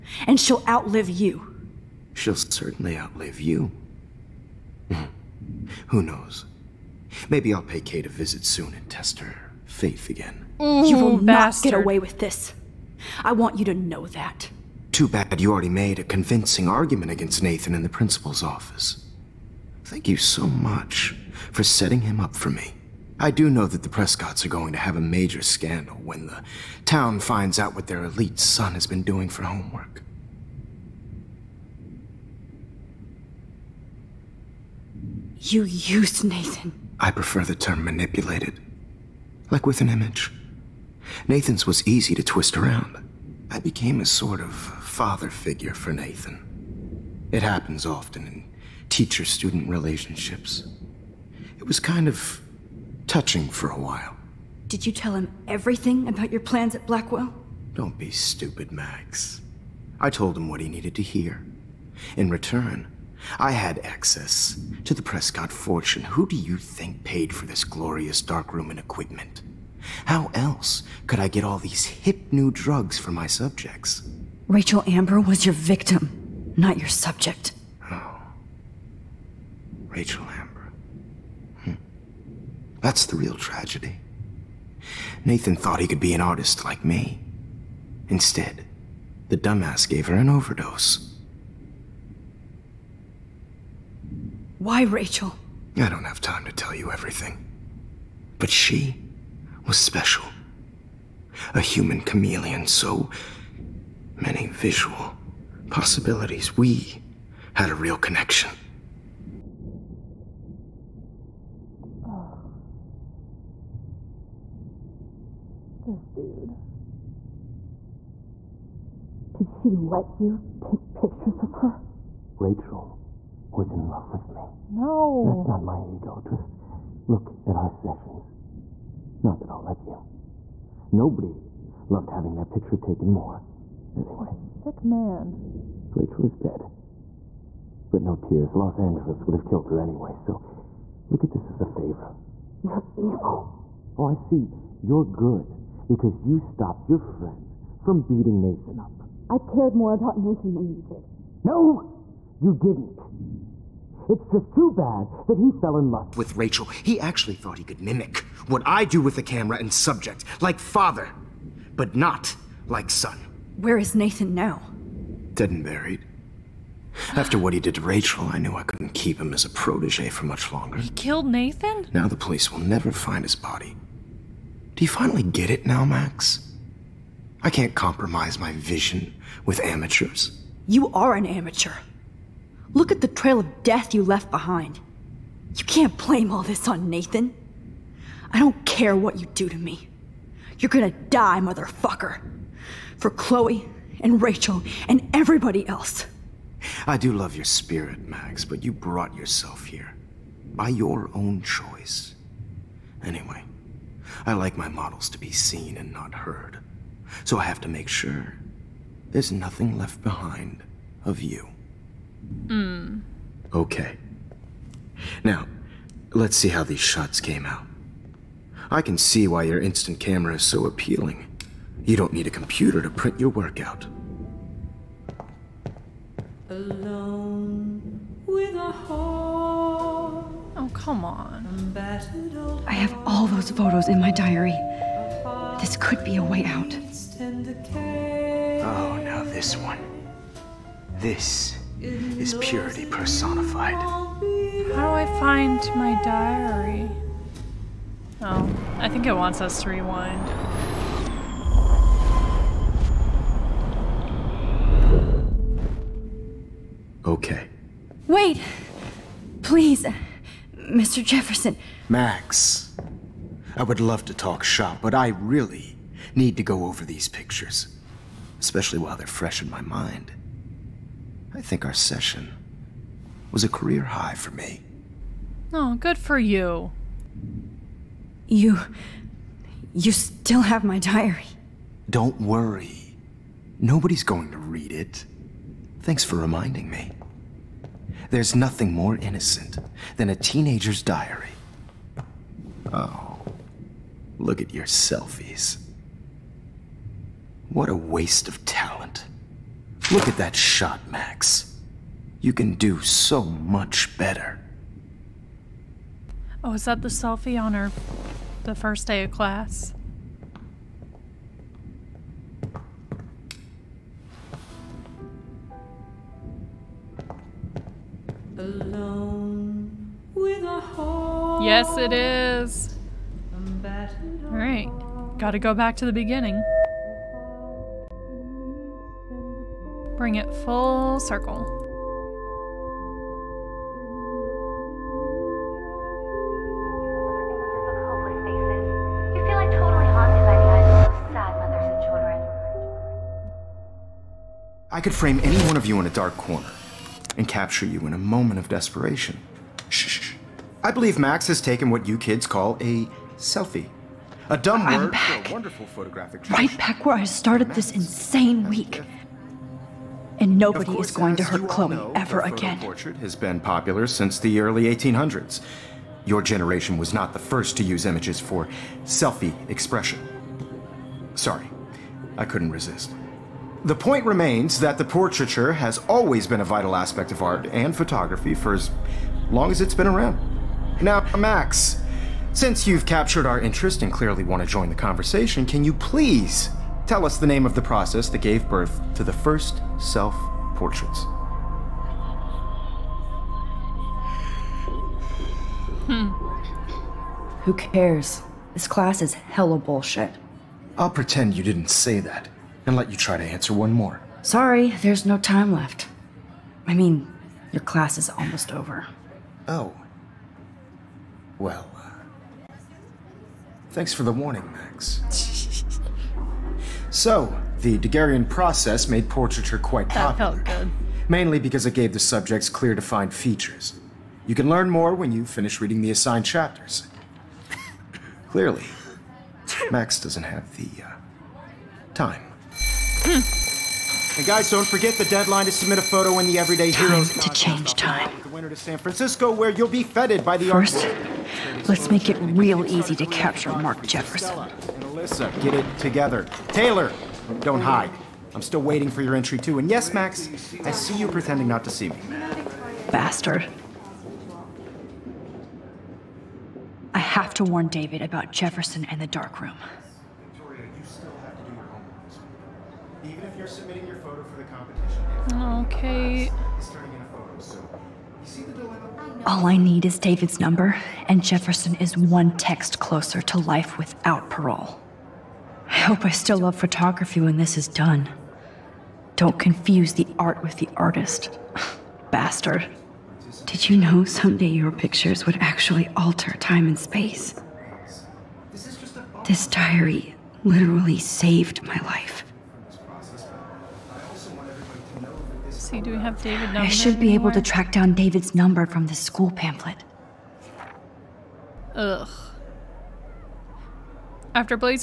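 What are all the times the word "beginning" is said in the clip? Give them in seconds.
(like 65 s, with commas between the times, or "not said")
325 s.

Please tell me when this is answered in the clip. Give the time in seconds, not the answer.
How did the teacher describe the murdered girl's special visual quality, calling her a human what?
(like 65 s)
101 s.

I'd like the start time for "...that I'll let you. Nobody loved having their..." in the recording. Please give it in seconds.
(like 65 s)
129 s.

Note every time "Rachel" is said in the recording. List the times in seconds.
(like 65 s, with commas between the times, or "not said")
74 s, 79 s, 94 s, 122 s, 135 s, 156 s, 167 s, 194 s.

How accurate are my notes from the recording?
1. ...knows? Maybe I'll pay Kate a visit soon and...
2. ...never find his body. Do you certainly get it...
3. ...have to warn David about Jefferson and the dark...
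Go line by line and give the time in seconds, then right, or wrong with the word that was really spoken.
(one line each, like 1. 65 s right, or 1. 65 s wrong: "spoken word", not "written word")
1. 6 s right
2. 172 s wrong: "finally", not "certainly"
3. 456 s right.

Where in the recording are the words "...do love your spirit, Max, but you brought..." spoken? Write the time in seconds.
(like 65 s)
196 s.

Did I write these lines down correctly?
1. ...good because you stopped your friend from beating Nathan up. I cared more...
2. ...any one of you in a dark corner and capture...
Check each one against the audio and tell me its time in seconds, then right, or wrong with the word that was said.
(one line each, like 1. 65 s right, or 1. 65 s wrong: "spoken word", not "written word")
1. 145 s right
2. 345 s right.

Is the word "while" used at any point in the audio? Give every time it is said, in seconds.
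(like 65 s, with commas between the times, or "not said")
53 s, 268 s.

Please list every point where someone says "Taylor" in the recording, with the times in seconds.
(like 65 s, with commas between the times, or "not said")
446 s.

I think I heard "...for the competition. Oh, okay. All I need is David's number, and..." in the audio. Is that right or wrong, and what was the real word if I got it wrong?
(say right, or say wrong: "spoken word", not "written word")
right.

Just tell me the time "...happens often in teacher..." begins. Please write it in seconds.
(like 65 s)
47 s.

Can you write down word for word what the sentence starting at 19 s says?
Thank you so much for setting him up for me.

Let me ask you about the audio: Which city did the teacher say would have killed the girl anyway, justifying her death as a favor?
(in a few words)
Los Angeles.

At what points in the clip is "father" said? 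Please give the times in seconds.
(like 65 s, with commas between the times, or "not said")
44 s, 160 s.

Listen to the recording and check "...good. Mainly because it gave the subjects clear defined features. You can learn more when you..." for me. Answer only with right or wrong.
right.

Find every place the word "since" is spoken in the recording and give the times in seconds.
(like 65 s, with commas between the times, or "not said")
363 s, 382 s.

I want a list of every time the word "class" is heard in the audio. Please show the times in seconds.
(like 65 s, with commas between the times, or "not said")
309 s, 398 s, 407 s.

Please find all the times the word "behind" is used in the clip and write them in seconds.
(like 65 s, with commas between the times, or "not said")
184 s, 210 s.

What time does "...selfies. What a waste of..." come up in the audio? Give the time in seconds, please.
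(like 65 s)
294 s.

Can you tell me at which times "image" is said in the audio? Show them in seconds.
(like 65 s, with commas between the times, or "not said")
39 s, 367 s.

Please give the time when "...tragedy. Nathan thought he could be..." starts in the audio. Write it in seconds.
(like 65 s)
83 s.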